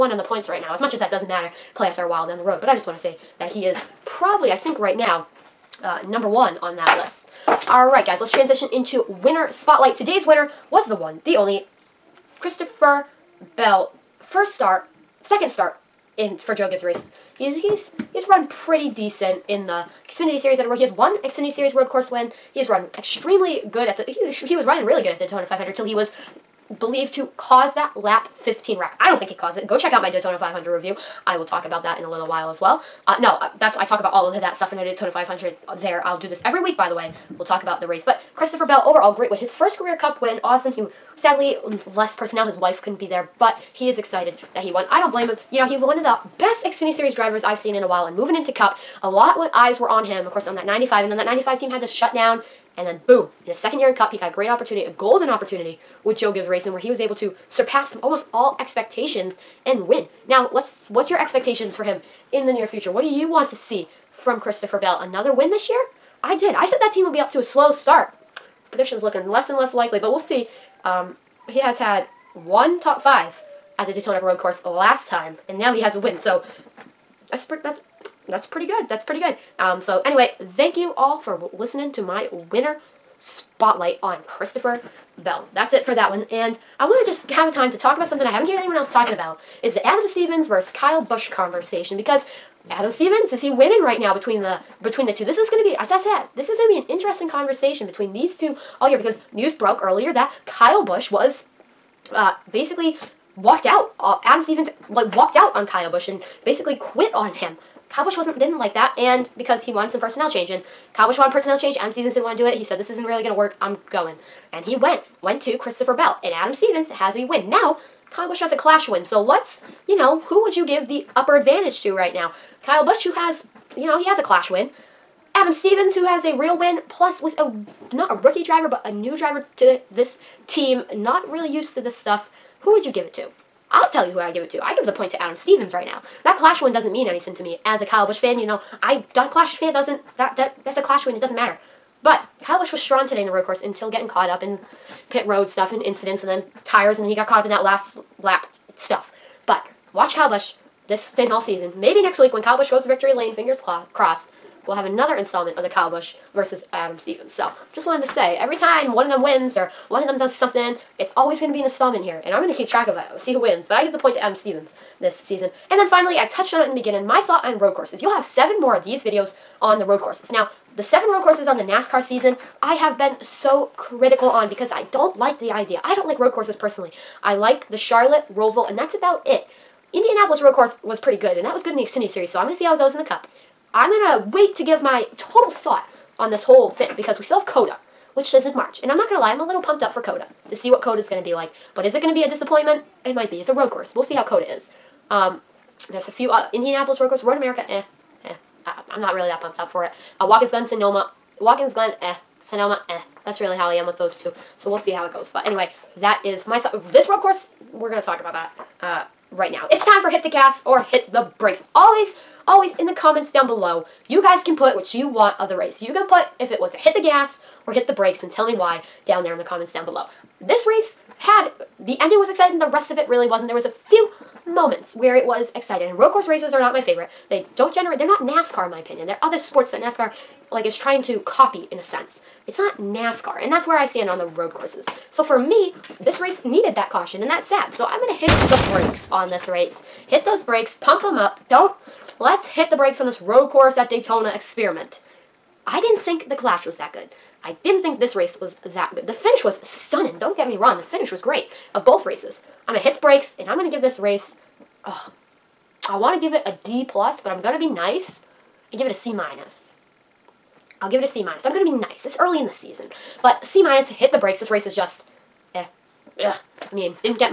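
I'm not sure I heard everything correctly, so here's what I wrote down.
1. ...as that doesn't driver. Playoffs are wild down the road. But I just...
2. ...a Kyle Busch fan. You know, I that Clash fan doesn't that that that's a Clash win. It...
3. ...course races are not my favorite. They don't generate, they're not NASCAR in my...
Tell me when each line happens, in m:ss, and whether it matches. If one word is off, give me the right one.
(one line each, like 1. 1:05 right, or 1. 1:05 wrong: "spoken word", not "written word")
1. 0:00 wrong: "matter", not "driver"
2. 2:17 right
3. 3:46 right.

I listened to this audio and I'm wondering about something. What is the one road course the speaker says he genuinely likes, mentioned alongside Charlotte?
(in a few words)
Roval.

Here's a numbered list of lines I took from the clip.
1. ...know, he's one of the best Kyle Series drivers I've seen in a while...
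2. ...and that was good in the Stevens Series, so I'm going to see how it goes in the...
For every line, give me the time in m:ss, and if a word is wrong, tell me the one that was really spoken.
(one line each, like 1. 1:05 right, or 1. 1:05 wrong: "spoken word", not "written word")
1. 0:45 wrong: "Xfinity", not "Kyle"
2. 3:01 wrong: "Xfinity", not "Stevens".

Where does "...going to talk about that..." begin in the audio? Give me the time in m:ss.
3:27.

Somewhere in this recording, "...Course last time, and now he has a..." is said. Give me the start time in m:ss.
1:14.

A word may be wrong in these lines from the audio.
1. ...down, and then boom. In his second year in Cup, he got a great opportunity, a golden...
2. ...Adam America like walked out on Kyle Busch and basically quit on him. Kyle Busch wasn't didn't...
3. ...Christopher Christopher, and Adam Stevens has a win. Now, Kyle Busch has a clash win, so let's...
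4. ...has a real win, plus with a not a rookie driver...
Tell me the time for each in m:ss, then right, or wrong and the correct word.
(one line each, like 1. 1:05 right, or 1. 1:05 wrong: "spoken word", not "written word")
1. 0:52 right
2. 1:44 wrong: "Stevens", not "America"
3. 1:55 wrong: "Bell", not "Christopher"
4. 2:06 right.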